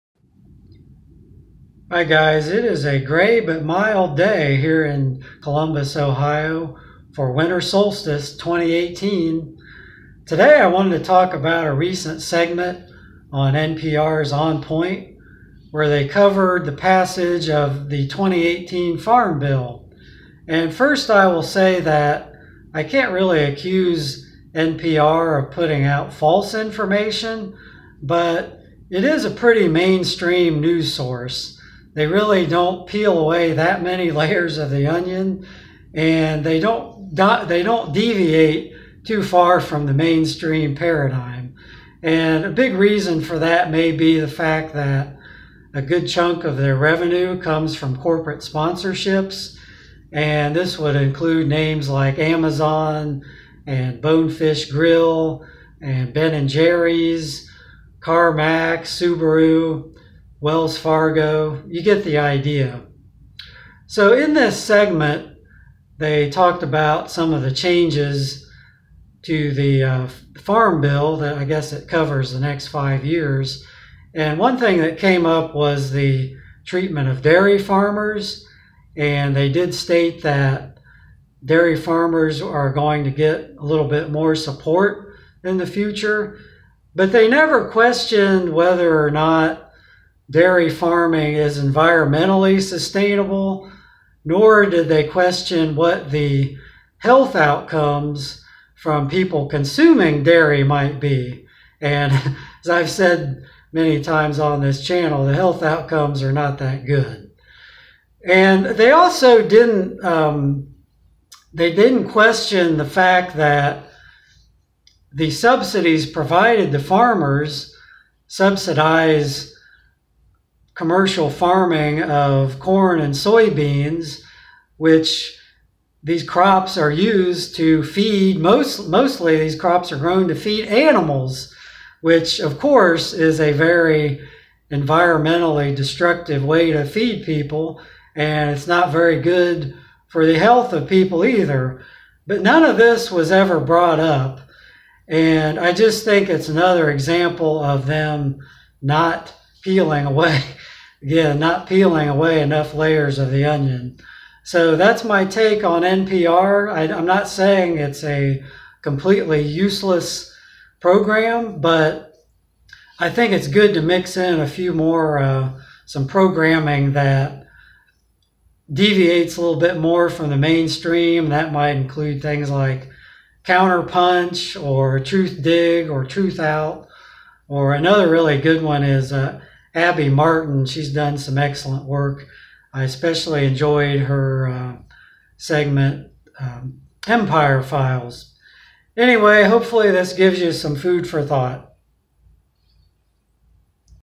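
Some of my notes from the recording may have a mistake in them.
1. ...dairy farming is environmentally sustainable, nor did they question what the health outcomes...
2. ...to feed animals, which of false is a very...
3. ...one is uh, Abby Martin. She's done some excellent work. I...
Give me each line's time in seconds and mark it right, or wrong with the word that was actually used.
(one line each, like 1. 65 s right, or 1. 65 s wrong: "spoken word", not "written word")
1. 90 s right
2. 130 s wrong: "course", not "false"
3. 178 s right.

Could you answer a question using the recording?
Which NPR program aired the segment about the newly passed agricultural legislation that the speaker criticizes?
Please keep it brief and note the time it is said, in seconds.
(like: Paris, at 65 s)
On Point, at 14 s.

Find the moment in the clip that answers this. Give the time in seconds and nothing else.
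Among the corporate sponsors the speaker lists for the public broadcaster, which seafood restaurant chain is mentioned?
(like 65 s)
54 s.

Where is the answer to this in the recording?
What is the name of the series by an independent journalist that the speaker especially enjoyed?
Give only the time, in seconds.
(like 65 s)
187 s.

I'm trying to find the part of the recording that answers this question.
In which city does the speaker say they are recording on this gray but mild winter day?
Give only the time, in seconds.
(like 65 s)
5 s.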